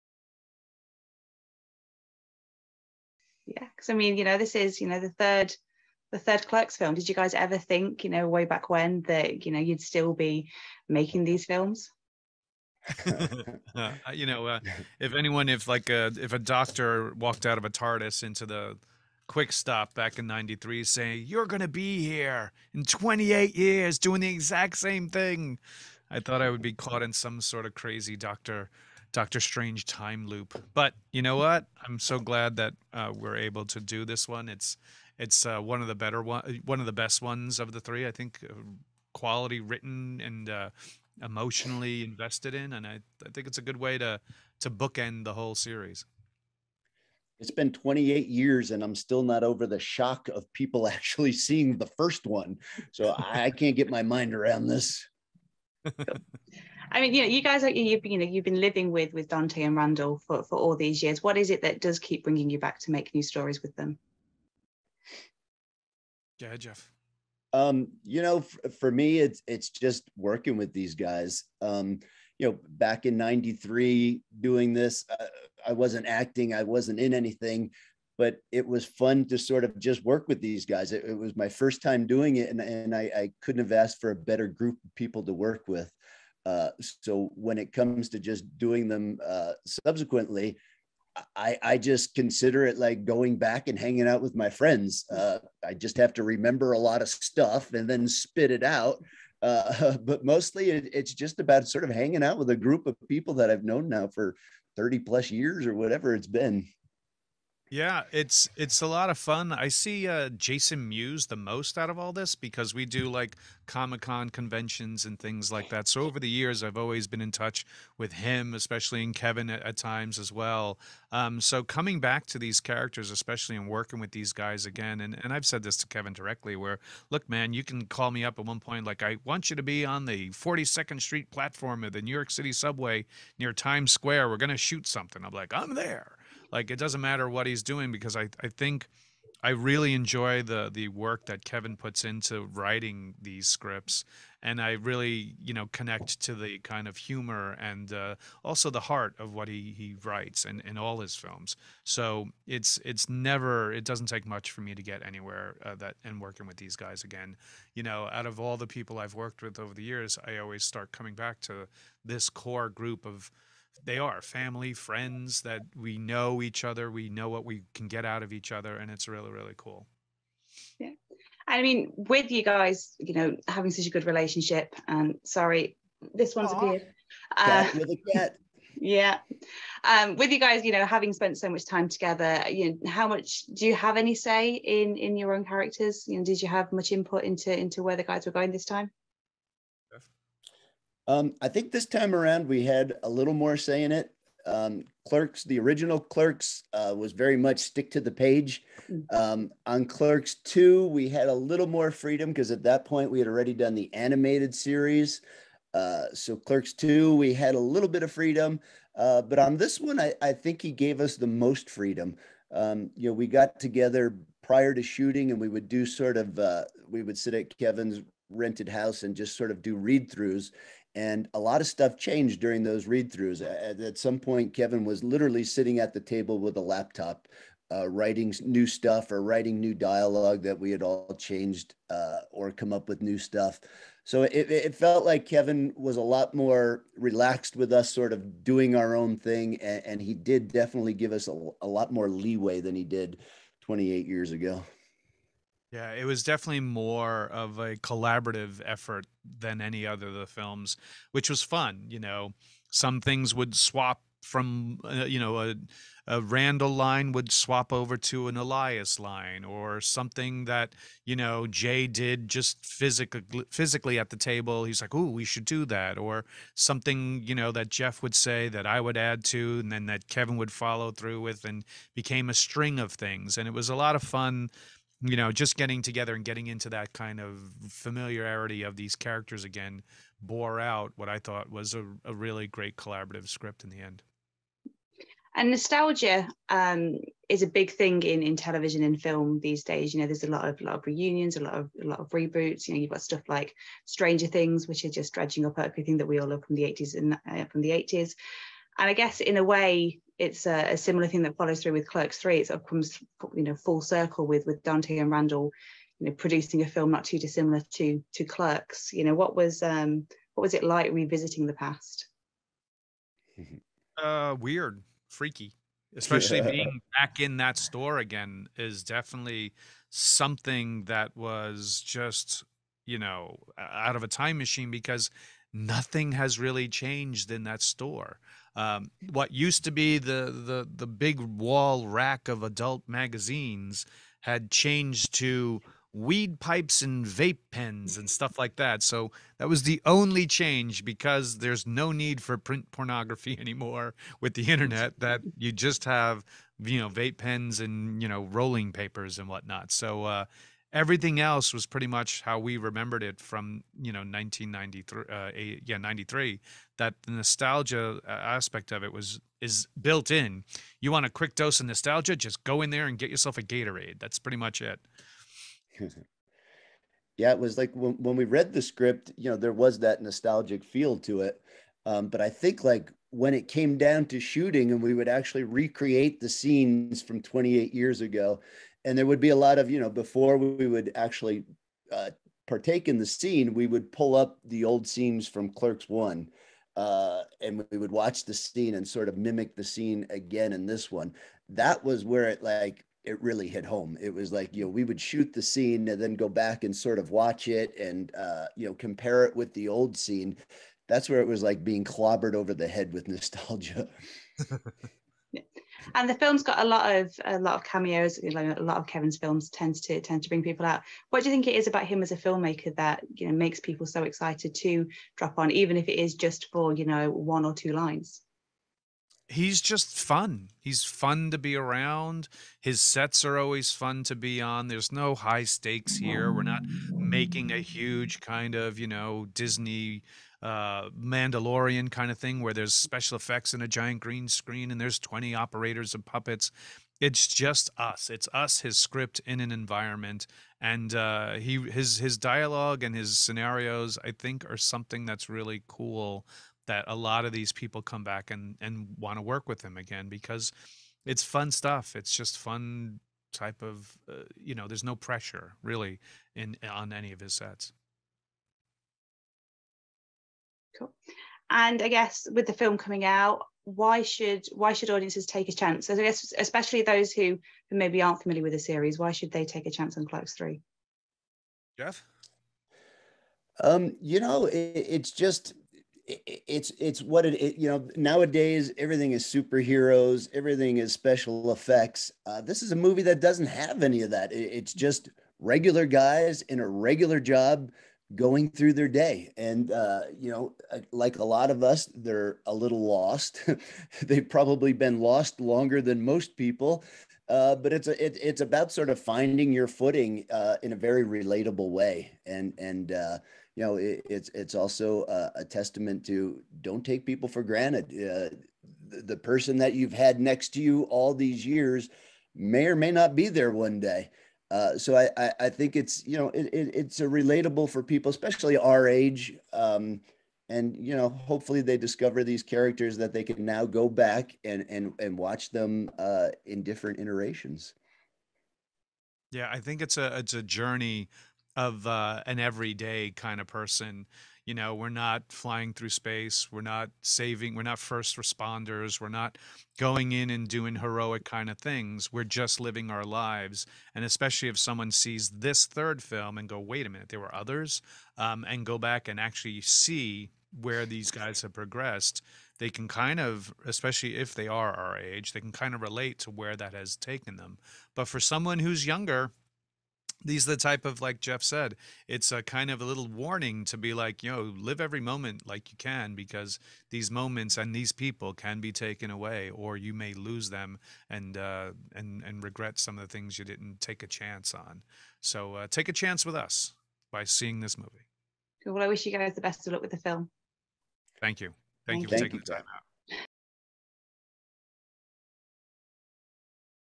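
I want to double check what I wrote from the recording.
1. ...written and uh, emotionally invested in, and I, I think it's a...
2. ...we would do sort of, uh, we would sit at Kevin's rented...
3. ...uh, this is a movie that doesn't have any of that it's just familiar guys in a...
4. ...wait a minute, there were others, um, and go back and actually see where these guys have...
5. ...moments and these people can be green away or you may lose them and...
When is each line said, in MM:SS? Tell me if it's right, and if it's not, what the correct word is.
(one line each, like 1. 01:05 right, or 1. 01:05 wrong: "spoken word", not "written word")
1. 00:39 right
2. 03:35 right
3. 08:02 wrong: "regular", not "familiar"
4. 09:06 right
5. 09:27 wrong: "taken", not "green".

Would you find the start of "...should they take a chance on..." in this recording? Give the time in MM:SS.
07:49.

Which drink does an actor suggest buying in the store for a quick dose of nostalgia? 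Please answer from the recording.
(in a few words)
Gatorade.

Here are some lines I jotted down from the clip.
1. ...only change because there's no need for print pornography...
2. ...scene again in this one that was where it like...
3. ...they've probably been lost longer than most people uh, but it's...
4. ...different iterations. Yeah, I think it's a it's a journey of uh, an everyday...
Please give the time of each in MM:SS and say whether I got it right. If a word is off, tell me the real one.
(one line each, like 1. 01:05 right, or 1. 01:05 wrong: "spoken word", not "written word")
1. 05:39 right
2. 06:29 right
3. 08:14 right
4. 08:46 right.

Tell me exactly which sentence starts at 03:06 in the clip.
You know, did you have much input into into where the guys were going this time?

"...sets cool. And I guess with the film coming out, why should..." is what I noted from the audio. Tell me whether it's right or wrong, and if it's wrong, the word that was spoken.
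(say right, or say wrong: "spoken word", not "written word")
right.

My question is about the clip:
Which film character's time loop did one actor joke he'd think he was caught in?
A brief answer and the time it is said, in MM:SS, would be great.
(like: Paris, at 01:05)
Doctor Strange, at 00:29.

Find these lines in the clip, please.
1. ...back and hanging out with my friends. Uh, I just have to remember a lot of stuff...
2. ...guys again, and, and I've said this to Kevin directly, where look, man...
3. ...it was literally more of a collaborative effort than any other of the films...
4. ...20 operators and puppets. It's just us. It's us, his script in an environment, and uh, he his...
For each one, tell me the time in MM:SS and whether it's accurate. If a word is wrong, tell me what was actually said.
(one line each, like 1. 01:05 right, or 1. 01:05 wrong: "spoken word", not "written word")
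1. 01:33 right
2. 02:04 right
3. 04:05 wrong: "definitely", not "literally"
4. 07:14 right.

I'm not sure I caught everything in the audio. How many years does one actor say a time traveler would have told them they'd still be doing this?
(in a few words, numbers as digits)
28.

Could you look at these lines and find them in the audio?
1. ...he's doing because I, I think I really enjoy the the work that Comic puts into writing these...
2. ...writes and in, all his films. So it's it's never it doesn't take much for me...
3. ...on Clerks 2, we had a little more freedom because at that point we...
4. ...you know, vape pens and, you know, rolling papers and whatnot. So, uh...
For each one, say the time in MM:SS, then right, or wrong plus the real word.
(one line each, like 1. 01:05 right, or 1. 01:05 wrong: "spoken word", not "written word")
1. 02:17 wrong: "Kevin", not "Comic"
2. 02:30 right
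3. 03:19 right
4. 05:46 right.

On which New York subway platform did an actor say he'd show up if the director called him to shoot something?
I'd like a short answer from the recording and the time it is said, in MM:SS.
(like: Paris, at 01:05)
42nd Street, at 02:10.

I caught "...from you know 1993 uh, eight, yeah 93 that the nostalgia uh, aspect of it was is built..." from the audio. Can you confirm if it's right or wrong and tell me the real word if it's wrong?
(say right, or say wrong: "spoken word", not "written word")
right.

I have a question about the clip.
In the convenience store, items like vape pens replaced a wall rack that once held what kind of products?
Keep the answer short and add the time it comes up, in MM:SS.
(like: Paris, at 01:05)
adult magazines, at 05:32.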